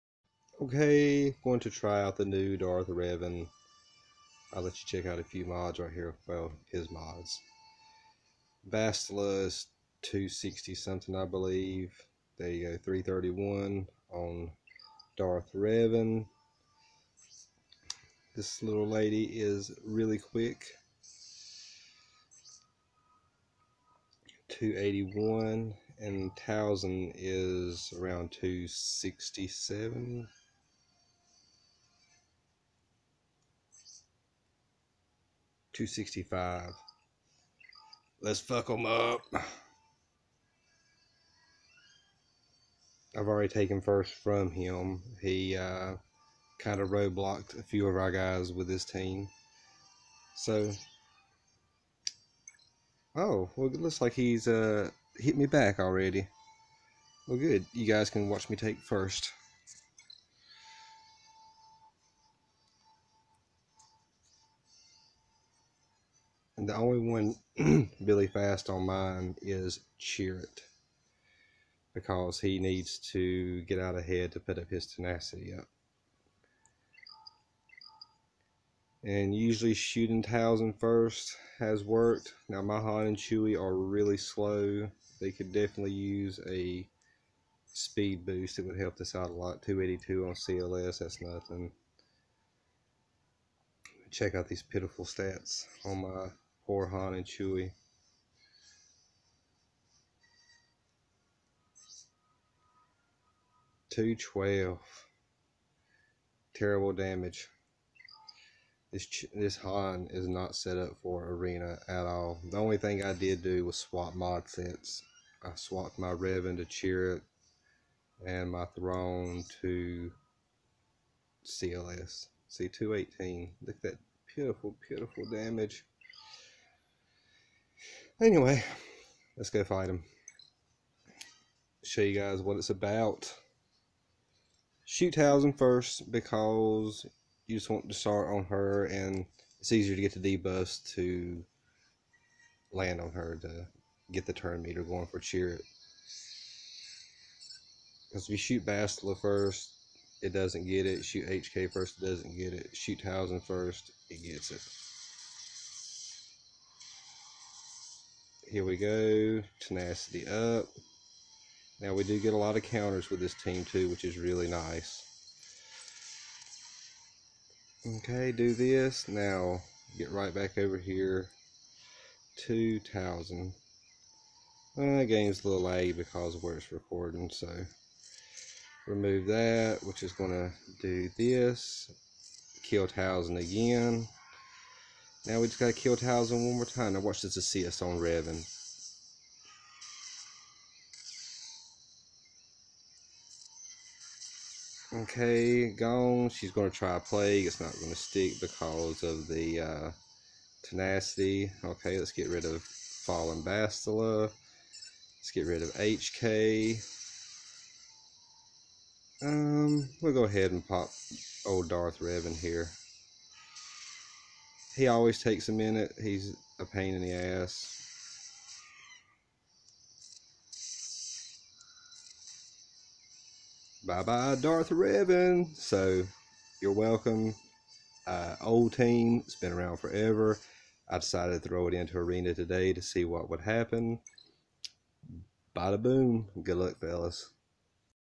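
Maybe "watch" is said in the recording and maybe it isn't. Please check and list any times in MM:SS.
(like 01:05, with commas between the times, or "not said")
00:58, 03:06.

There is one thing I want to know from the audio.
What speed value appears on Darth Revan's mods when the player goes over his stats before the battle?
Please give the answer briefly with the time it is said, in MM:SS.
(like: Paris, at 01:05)
331, at 00:12.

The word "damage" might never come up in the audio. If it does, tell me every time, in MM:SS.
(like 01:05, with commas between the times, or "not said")
01:46, 02:05.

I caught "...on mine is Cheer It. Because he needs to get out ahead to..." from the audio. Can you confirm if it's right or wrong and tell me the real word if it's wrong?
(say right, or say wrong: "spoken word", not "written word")
right.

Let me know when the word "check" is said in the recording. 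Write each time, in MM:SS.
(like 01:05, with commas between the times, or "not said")
00:04, 01:34.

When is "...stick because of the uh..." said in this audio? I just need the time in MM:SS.
03:17.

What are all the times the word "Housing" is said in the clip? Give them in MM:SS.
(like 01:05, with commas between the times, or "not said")
02:15, 02:33.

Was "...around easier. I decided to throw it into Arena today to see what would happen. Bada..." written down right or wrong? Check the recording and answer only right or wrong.
wrong.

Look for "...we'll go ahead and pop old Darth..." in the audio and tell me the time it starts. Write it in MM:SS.
03:30.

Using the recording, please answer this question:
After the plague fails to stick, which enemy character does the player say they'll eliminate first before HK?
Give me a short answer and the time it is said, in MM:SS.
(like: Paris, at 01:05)
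Fallen Bastila, at 03:22.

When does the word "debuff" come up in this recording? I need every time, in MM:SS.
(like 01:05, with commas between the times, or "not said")
02:20.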